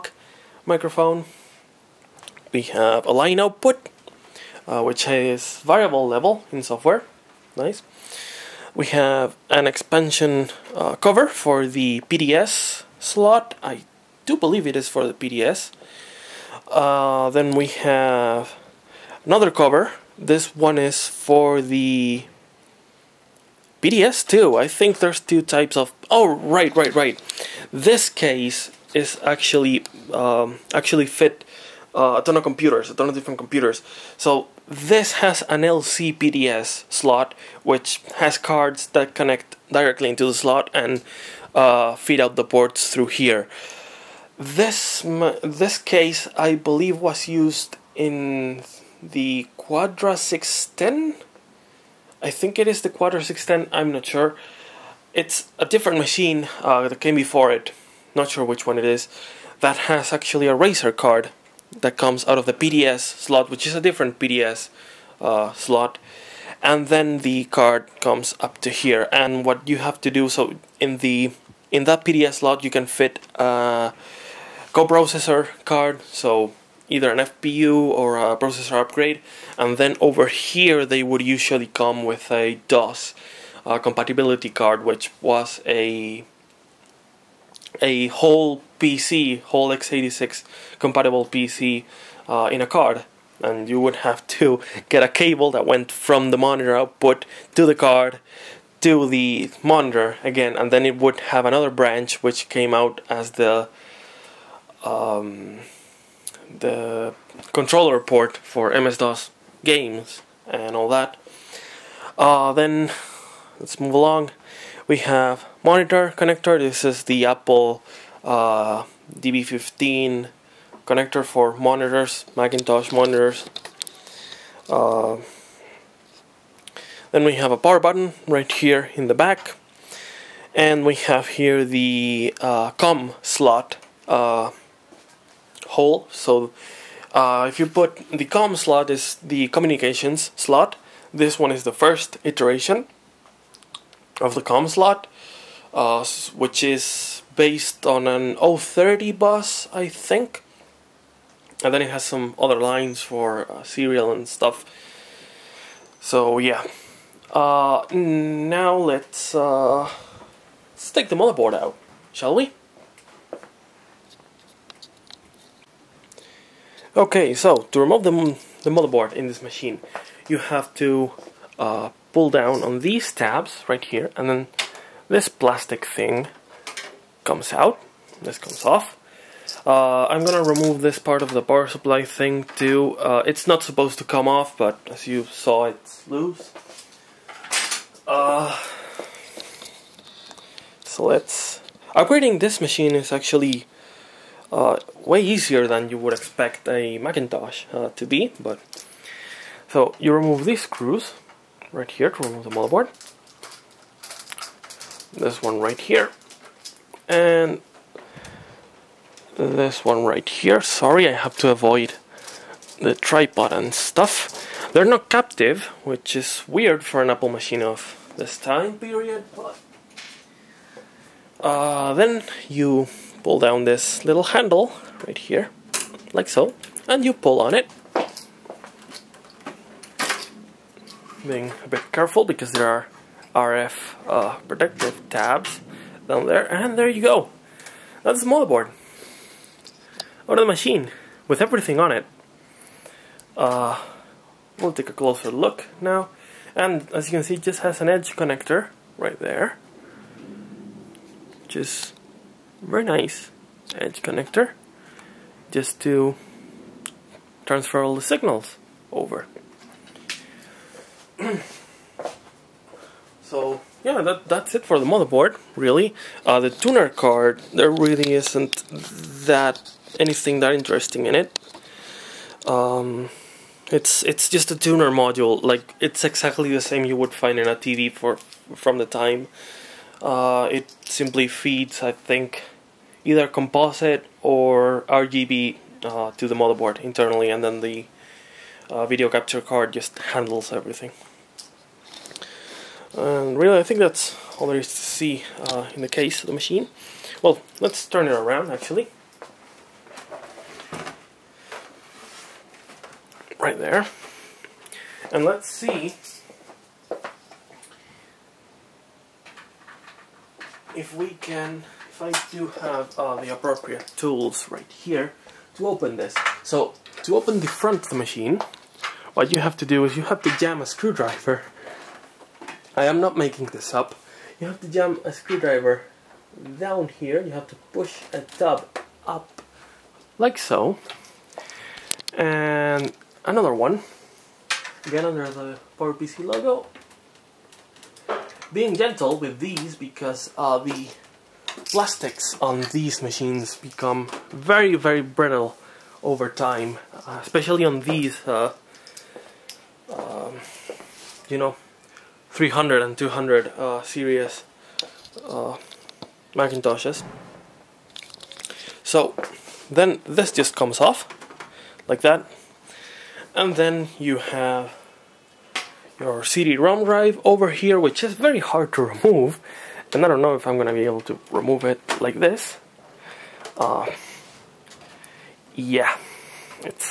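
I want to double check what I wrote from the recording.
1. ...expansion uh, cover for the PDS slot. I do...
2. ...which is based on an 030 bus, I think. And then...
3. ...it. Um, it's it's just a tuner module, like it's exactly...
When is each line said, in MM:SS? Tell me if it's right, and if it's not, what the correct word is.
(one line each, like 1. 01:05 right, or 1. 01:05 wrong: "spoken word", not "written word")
1. 00:09 right
2. 02:26 right
3. 04:31 right.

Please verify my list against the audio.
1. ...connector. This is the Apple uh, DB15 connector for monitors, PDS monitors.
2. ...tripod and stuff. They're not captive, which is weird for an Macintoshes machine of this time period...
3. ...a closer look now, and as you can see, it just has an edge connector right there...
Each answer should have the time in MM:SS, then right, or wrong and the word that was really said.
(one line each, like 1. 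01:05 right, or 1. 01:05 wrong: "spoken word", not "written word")
1. 01:56 wrong: "Macintosh", not "PDS"
2. 03:32 wrong: "Apple", not "Macintoshes"
3. 04:04 right.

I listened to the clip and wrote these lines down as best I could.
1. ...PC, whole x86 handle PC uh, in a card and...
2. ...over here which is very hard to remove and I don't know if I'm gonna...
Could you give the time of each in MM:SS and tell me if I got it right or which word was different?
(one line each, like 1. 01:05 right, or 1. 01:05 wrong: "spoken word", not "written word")
1. 01:28 wrong: "compatible", not "handle"
2. 06:07 right.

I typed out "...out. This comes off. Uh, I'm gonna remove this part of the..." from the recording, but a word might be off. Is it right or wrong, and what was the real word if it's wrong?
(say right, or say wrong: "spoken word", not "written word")
right.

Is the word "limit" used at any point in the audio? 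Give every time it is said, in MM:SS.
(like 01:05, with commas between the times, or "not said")
not said.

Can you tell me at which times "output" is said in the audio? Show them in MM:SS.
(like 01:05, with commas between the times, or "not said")
00:03, 01:36.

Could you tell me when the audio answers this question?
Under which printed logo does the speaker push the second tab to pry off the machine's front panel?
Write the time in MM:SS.
05:35.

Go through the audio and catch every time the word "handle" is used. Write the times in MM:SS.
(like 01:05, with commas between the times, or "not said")
03:44, 04:50.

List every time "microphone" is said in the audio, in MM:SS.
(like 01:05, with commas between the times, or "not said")
00:00.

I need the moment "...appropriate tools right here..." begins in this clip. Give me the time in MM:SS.
05:13.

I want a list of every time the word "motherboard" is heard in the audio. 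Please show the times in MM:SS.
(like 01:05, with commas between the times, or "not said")
02:41, 02:48, 03:22, 03:58, 04:24, 04:46.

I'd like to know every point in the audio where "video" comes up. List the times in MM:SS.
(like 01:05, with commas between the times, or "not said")
04:48.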